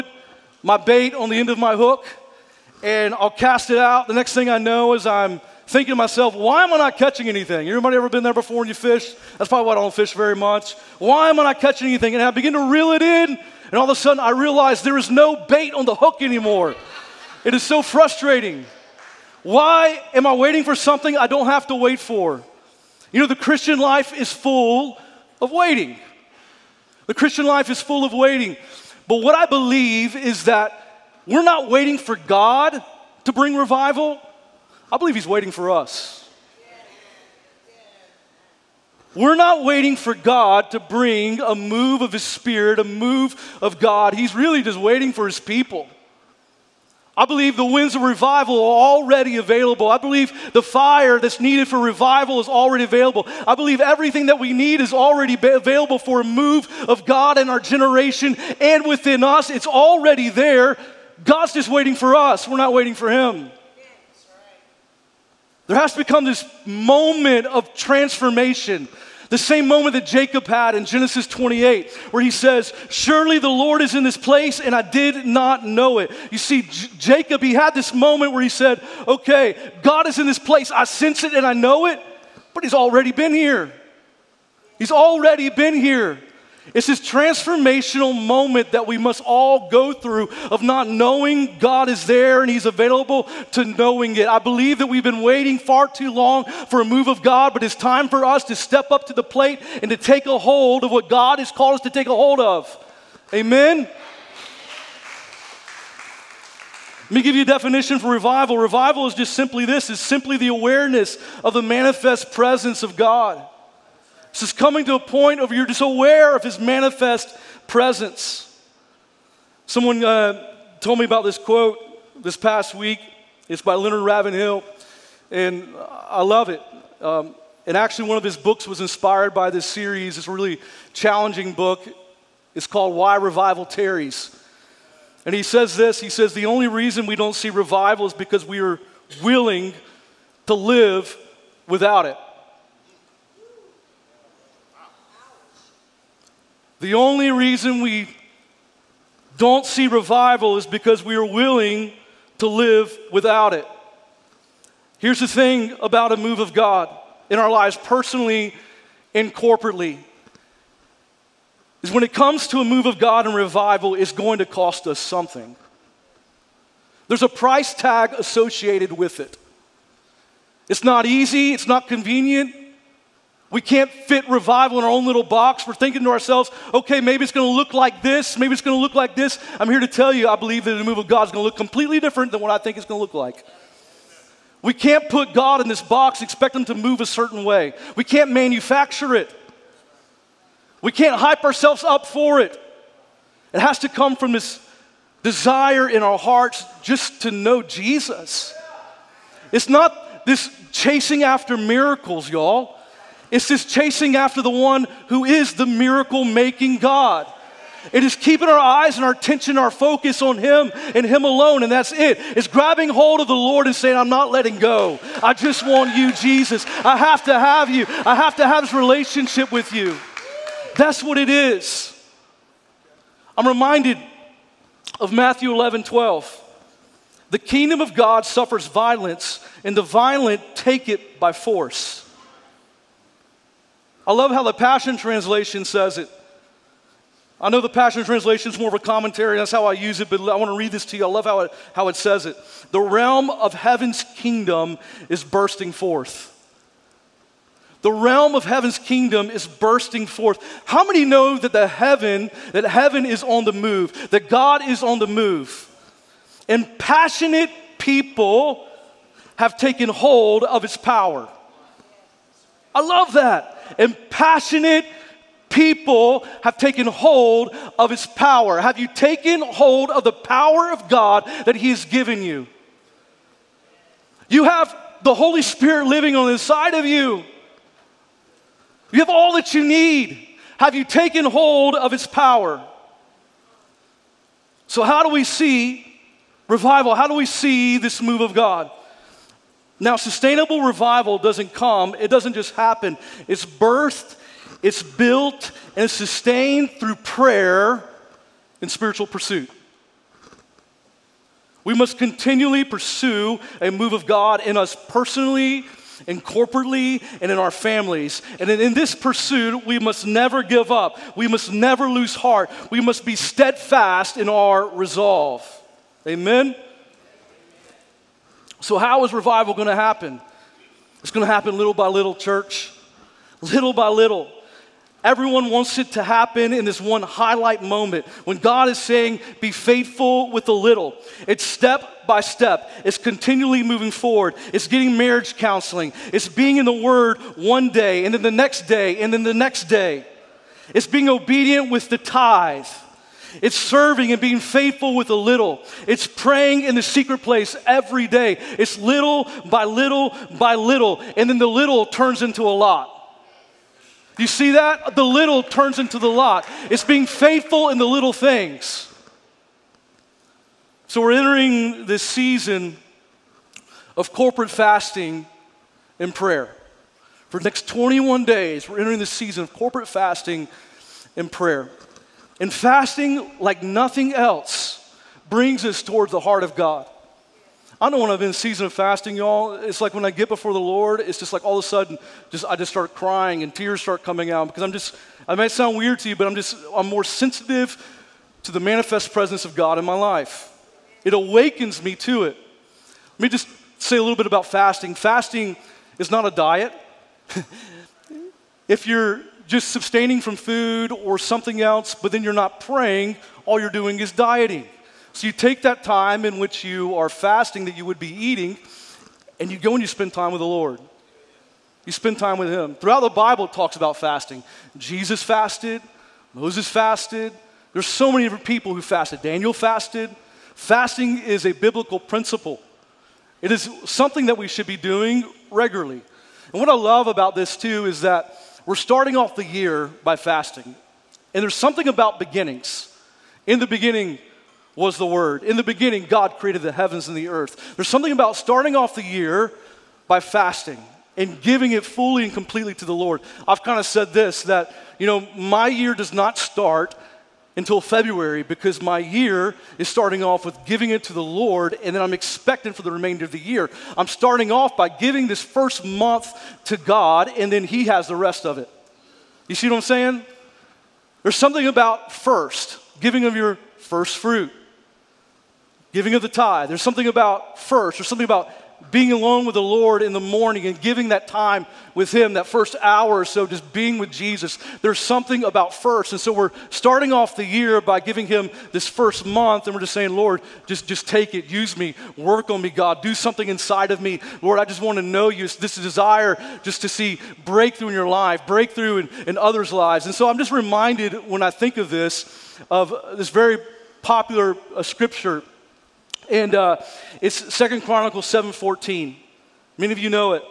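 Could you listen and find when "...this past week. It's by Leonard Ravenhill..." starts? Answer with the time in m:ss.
2:02.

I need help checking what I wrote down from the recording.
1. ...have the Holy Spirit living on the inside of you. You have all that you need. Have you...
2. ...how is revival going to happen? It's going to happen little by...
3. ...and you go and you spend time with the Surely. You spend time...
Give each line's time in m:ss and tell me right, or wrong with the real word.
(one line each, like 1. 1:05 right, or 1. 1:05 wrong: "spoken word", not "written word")
1. 4:34 right
2. 5:18 right
3. 6:49 wrong: "Lord", not "Surely".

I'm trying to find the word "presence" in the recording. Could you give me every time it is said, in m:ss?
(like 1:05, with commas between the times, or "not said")
1:52, 1:57, 6:29.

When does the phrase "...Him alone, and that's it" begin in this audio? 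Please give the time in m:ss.
3:31.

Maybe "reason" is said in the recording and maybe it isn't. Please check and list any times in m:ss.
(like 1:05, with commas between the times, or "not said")
2:16, 2:27.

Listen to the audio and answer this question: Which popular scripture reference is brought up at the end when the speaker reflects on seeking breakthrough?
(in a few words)
2 Chronicles 7:14.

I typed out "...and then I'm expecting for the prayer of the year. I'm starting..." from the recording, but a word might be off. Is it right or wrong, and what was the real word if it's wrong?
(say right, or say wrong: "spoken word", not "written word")
wrong: "remainder", not "prayer".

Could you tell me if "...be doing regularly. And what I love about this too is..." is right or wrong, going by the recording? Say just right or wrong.
right.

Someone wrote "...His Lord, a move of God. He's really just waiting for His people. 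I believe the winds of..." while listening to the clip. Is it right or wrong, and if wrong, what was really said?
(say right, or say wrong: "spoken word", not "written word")
wrong: "Spirit", not "Lord".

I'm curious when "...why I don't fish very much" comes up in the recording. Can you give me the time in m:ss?
0:09.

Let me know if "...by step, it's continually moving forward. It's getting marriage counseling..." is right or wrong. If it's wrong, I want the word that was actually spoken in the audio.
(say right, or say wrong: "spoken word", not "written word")
right.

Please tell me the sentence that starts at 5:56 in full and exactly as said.
It's being faithful in the little things.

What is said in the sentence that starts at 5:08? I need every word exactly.
And in this pursuit, we must never give up.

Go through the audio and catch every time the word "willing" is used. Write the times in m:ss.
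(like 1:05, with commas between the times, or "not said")
2:19, 2:31.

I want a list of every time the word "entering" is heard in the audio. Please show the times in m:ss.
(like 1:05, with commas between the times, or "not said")
6:01, 6:08.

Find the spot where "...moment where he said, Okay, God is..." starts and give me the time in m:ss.
1:17.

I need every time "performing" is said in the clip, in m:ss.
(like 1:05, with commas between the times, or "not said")
not said.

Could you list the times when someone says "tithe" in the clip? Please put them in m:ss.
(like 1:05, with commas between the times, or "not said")
5:41, 7:46.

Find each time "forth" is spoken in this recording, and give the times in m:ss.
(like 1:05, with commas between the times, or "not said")
4:05, 4:10.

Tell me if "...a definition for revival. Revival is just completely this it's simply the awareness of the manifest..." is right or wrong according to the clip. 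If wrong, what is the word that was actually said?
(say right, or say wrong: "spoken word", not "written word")
wrong: "simply", not "completely".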